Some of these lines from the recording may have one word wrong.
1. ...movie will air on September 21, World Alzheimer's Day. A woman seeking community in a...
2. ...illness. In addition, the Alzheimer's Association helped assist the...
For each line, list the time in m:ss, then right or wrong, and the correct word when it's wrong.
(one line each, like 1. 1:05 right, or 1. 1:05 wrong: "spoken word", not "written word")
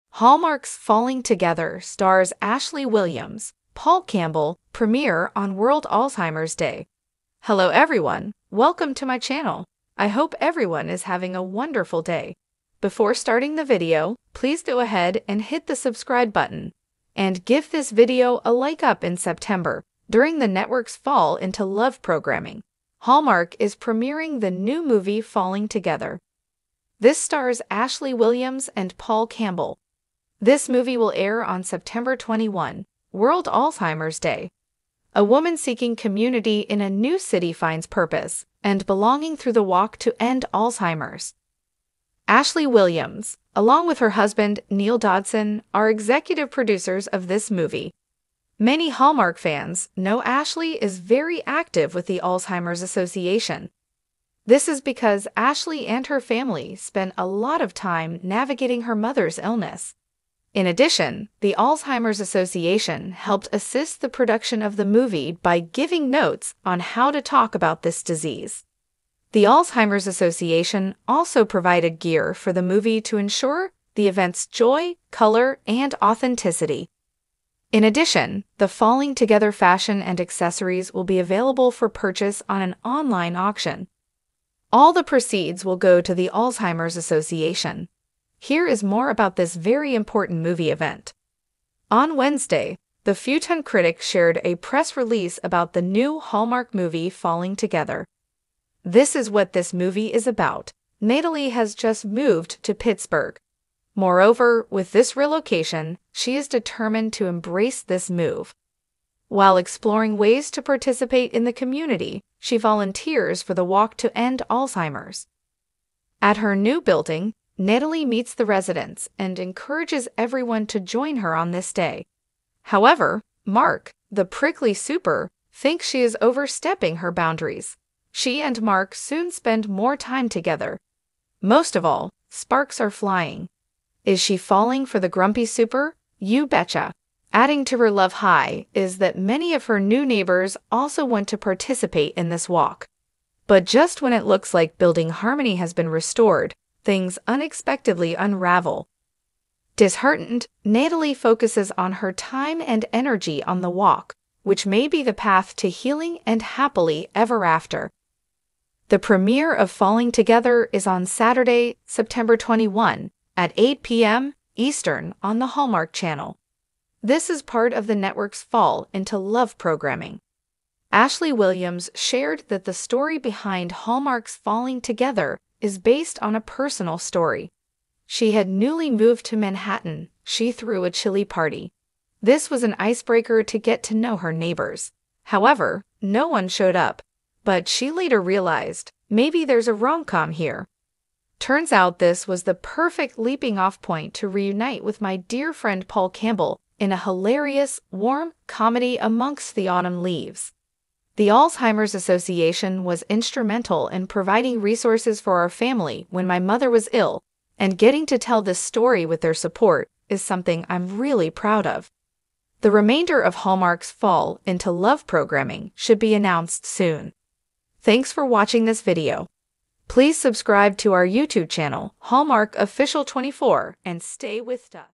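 1. 0:30 right
2. 0:59 right.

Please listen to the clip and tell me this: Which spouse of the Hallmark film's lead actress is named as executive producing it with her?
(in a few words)
Neal Dodson.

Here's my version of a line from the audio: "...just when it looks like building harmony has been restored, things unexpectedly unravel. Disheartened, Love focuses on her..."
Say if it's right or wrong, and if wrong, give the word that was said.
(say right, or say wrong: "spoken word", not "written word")
wrong: "Natalie", not "Love".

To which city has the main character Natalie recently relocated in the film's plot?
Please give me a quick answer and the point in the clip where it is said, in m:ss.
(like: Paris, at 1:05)
Pittsburgh, at 1:42.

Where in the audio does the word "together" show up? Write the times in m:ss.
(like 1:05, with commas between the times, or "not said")
0:01, 0:25, 1:19, 1:37, 2:10, 2:40, 2:54.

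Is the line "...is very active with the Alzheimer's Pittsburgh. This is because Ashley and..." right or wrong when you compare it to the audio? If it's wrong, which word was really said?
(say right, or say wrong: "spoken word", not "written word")
wrong: "Association", not "Pittsburgh".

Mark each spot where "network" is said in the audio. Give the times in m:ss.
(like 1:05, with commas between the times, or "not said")
0:20, 2:47.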